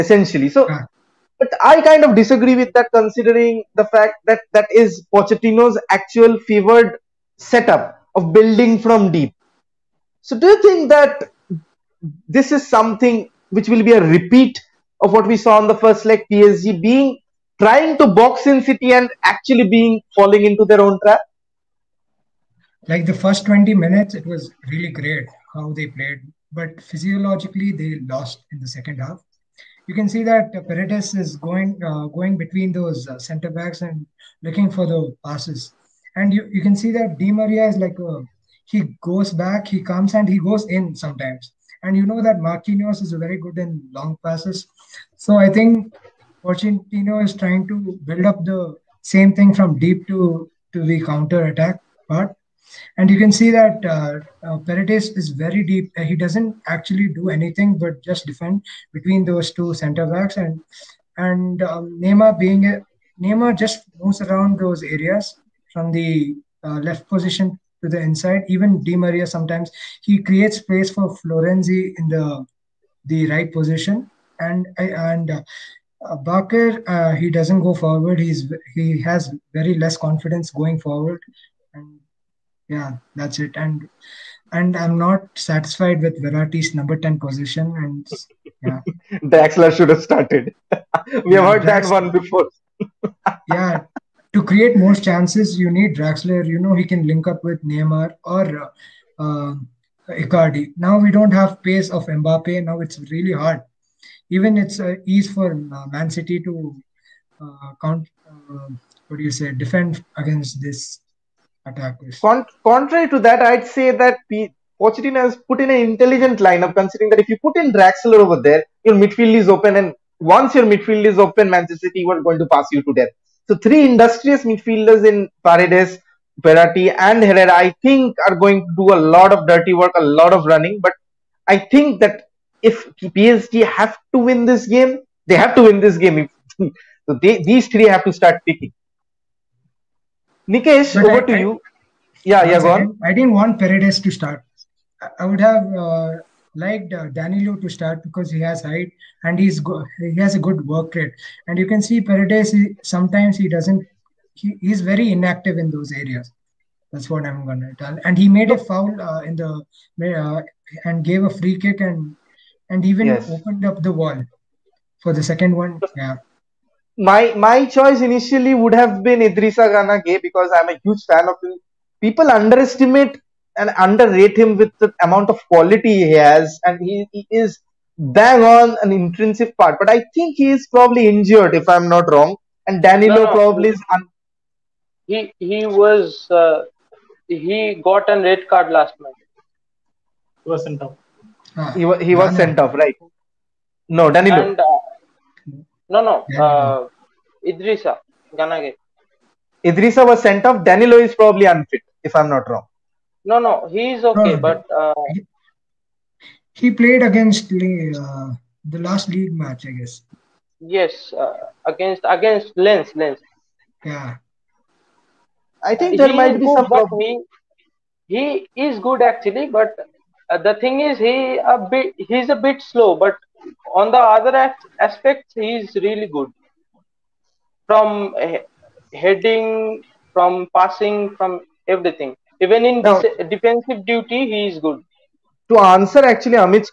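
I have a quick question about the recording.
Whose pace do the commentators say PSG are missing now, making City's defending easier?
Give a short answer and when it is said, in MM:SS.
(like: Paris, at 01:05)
Mbappe, at 01:42.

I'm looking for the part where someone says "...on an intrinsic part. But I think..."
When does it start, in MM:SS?
02:58.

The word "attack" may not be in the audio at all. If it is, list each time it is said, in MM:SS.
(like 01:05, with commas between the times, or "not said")
00:51, 01:51.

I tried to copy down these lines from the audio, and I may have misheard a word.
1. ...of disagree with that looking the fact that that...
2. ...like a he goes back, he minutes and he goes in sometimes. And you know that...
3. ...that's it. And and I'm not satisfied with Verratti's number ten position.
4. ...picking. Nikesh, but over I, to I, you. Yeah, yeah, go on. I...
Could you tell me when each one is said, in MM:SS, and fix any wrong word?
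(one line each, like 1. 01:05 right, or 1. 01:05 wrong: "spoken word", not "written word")
1. 00:02 wrong: "considering", not "looking"
2. 00:37 wrong: "comes", not "minutes"
3. 01:23 right
4. 02:18 right.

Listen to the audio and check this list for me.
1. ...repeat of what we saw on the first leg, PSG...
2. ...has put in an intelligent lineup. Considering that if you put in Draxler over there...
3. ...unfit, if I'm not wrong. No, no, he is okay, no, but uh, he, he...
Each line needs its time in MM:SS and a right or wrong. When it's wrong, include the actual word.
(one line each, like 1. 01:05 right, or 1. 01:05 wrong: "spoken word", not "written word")
1. 00:14 right
2. 01:55 right
3. 03:21 right.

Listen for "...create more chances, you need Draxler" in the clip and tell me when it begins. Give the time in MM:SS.
01:34.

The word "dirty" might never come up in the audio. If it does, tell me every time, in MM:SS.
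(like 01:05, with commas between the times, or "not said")
02:09.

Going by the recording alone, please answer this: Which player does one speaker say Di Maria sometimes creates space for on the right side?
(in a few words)
Florenzi.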